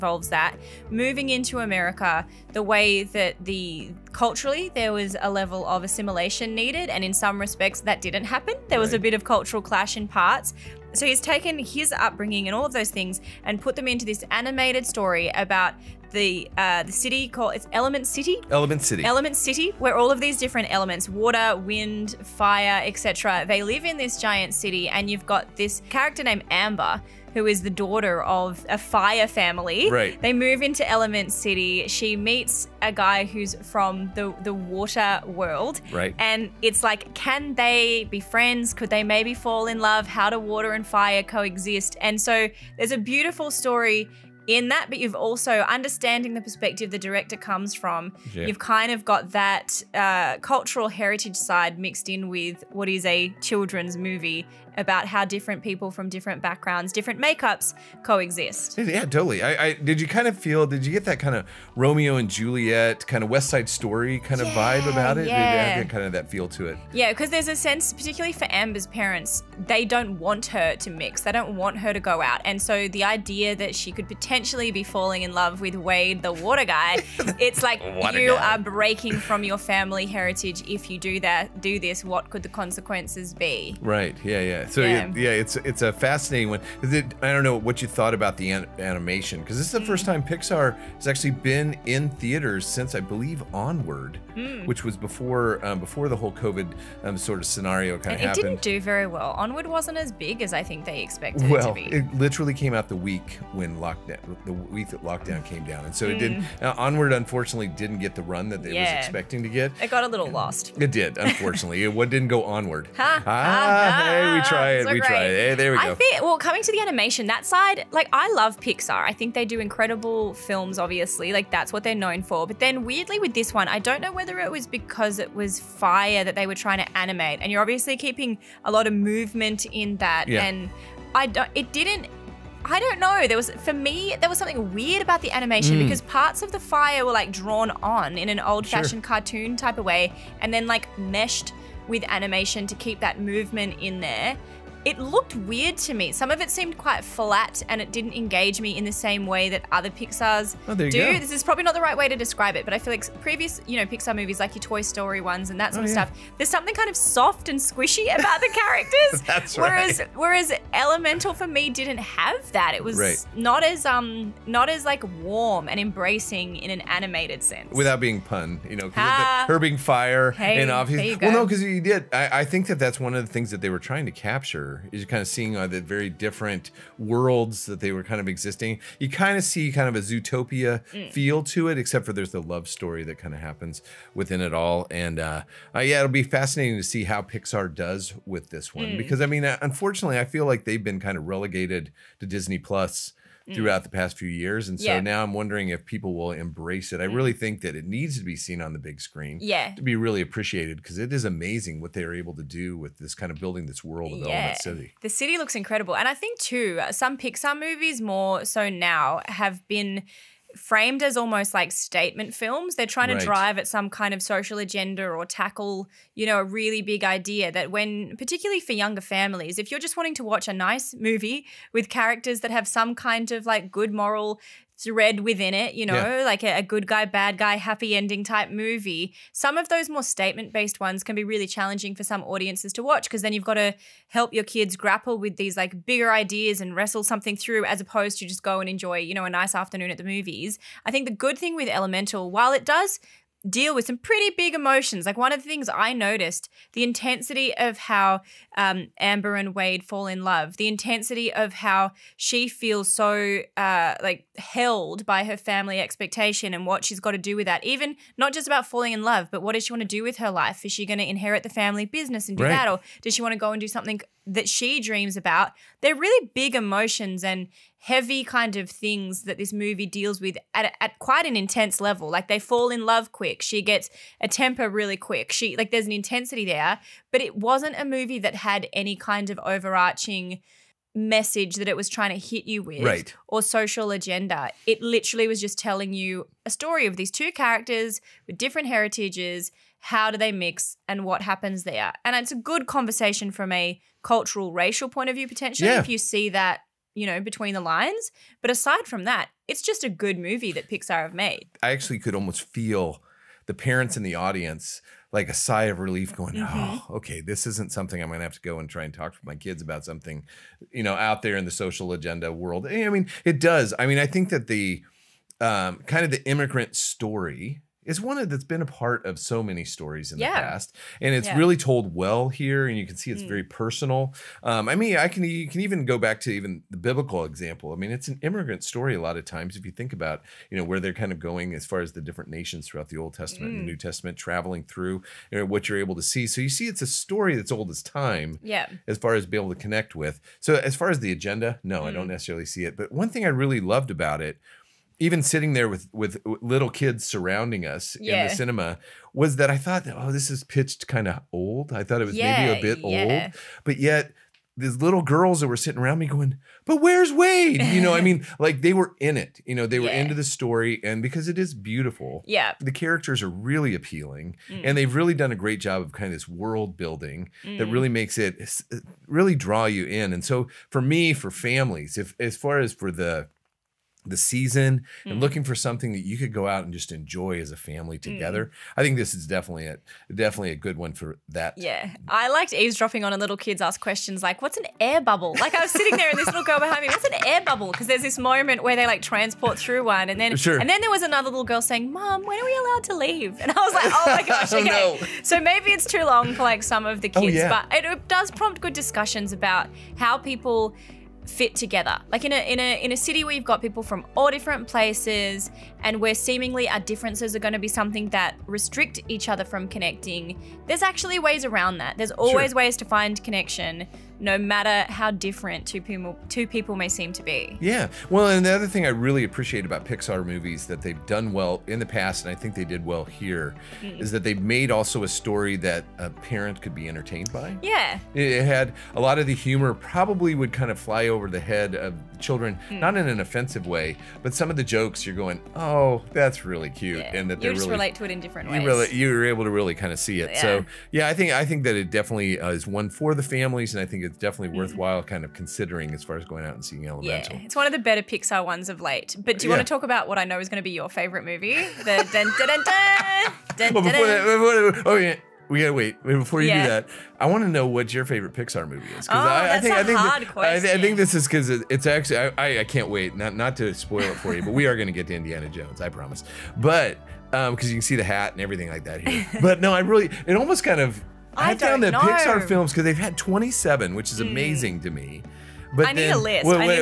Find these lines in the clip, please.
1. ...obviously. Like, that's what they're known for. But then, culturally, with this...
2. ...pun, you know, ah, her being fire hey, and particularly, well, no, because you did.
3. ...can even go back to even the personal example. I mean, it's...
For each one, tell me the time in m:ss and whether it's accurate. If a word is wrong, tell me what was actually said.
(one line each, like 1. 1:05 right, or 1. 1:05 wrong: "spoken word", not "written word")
1. 2:00 wrong: "weirdly", not "culturally"
2. 2:48 wrong: "obviously", not "particularly"
3. 5:25 wrong: "biblical", not "personal".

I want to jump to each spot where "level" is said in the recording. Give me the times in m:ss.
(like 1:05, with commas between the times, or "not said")
0:05, 4:31.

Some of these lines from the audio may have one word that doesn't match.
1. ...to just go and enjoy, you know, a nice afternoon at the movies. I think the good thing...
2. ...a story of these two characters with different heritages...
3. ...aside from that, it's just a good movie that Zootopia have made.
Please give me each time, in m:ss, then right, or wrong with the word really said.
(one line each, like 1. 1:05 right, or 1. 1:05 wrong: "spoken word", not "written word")
1. 3:58 right
2. 4:46 right
3. 4:58 wrong: "Pixar", not "Zootopia".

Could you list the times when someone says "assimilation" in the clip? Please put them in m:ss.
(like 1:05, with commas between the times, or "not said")
0:05.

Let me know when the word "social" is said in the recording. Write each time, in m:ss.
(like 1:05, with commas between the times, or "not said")
3:34, 4:43, 5:11.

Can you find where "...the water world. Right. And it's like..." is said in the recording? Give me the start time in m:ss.
0:34.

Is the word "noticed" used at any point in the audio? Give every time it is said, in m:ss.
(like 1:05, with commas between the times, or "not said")
4:05.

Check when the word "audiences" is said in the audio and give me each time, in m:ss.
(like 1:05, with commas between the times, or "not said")
3:52, 5:04.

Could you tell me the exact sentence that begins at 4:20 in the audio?
Is she going to inherit the family business and do right.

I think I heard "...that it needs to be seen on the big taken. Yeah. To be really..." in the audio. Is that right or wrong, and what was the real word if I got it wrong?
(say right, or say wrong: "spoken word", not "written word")
wrong: "screen", not "taken".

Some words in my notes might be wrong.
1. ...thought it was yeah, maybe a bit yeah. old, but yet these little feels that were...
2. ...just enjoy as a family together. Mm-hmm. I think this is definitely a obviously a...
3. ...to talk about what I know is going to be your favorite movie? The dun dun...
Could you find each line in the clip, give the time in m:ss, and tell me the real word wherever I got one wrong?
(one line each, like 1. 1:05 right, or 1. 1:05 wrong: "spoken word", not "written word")
1. 5:51 wrong: "girls", not "feels"
2. 6:16 wrong: "definitely", not "obviously"
3. 7:29 right.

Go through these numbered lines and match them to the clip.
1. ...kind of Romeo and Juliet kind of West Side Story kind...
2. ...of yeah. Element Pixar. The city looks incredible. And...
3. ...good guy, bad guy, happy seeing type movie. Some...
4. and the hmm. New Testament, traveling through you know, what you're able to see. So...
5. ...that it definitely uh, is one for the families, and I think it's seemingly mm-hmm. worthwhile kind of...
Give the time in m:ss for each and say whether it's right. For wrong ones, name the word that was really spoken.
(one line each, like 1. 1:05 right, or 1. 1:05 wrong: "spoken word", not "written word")
1. 1:01 right
2. 3:24 wrong: "City", not "Pixar"
3. 3:46 wrong: "ending", not "seeing"
4. 5:33 right
5. 7:21 wrong: "definitely", not "seemingly".